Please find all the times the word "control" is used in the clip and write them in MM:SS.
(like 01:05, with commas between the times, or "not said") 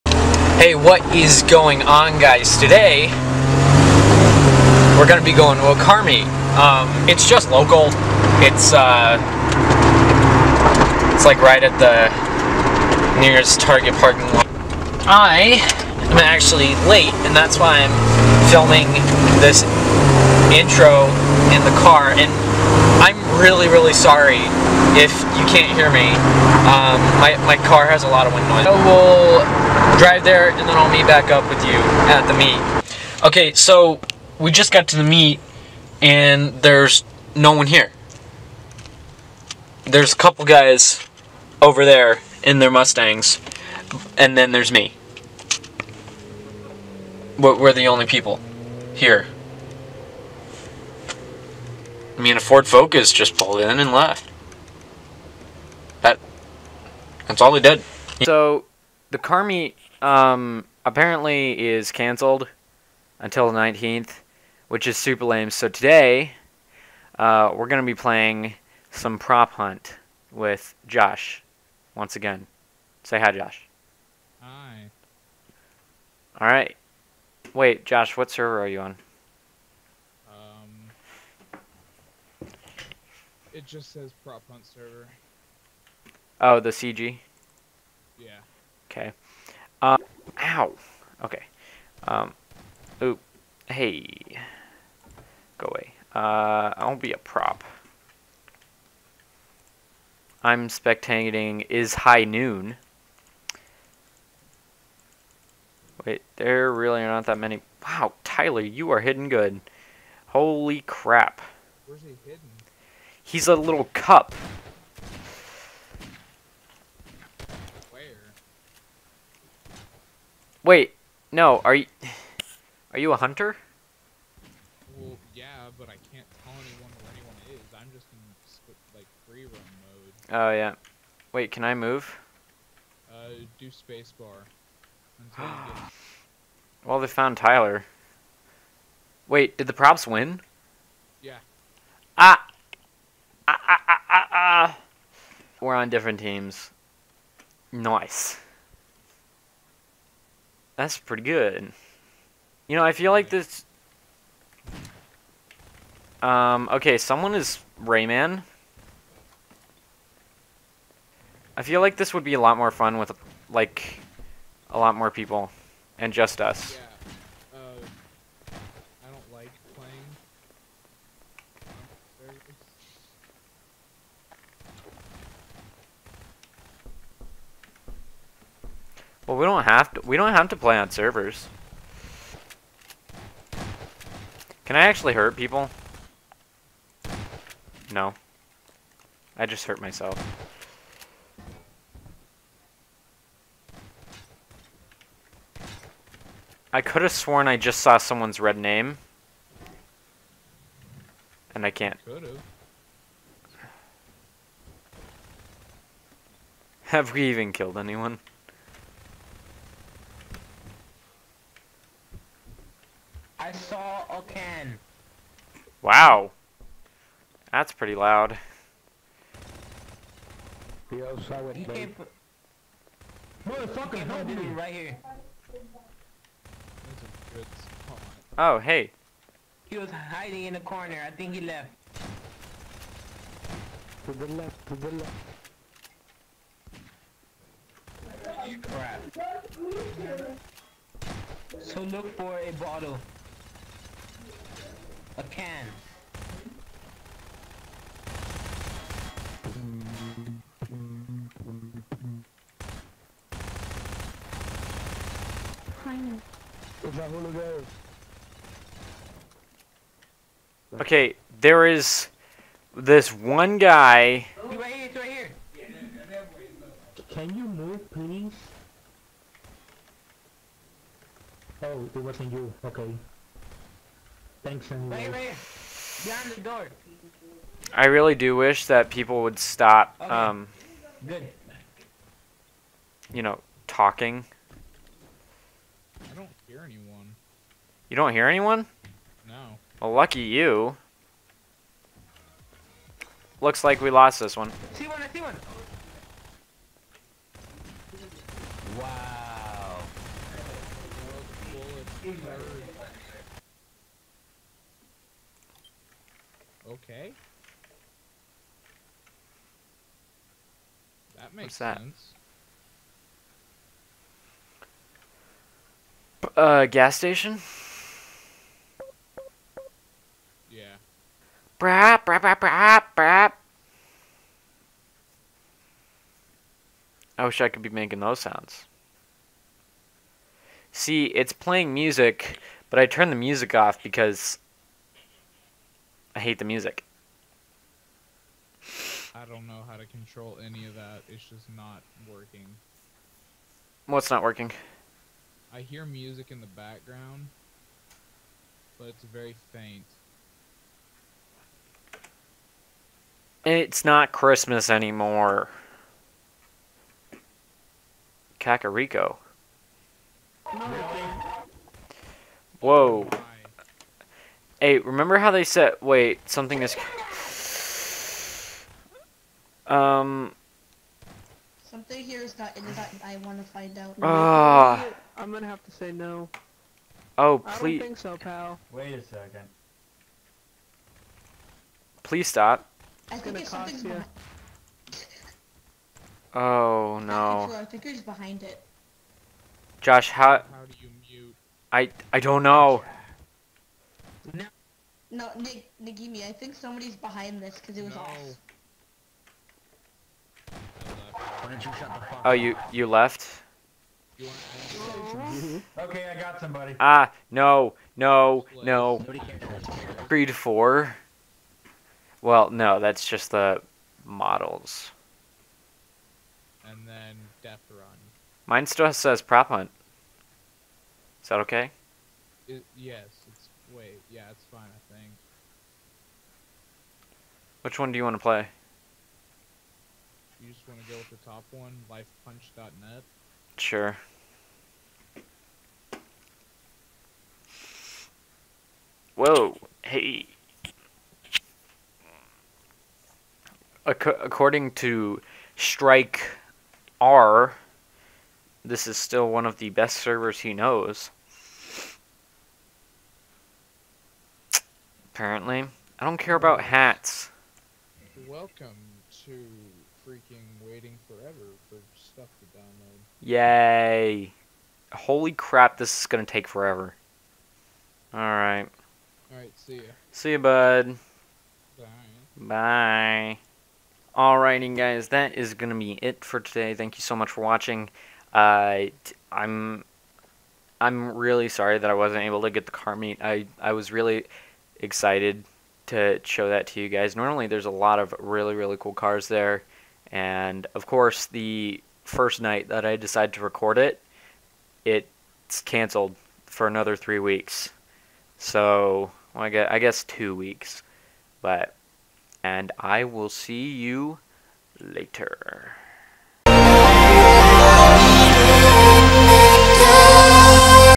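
05:39.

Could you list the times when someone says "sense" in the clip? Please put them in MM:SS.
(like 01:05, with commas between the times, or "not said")
05:11.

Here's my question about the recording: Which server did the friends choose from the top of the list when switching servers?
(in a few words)
lifepunch.net.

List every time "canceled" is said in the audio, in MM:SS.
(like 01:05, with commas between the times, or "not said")
01:01, 08:15.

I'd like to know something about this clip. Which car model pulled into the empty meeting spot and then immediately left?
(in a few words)
Ford Focus.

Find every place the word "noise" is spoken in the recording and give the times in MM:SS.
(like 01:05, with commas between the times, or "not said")
00:28.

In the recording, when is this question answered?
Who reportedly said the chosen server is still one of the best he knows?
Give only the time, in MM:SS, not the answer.
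07:25.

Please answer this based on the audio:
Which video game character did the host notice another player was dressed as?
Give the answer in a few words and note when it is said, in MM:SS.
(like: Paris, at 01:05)
Rayman, at 02:37.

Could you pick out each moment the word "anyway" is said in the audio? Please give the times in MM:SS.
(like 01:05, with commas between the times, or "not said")
04:34.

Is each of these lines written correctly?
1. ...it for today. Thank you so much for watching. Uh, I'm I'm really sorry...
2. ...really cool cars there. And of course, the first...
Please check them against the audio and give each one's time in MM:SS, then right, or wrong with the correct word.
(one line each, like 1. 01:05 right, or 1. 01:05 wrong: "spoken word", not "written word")
1. 07:56 right
2. 08:08 right.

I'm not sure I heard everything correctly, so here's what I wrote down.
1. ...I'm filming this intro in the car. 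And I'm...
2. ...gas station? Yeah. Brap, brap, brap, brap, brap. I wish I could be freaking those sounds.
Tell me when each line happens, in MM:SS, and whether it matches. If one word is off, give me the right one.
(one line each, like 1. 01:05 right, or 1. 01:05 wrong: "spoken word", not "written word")
1. 00:17 right
2. 05:16 wrong: "making", not "freaking".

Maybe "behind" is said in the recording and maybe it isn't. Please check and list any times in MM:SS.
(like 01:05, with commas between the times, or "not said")
04:36, 06:28, 06:36.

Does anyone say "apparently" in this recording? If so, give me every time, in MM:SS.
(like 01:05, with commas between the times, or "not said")
01:00, 07:35.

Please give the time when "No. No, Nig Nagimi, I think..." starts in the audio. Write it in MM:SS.
06:34.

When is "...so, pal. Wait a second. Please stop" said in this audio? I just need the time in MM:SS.
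06:17.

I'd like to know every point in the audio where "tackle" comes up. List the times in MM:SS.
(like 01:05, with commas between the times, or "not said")
not said.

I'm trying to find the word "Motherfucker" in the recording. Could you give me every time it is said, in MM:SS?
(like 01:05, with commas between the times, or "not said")
03:43.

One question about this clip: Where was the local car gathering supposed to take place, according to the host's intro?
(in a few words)
Target parking lot.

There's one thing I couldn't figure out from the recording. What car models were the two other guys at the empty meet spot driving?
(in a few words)
Mustangs.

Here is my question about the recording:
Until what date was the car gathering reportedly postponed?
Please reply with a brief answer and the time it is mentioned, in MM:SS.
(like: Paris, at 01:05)
the 19th, at 01:03.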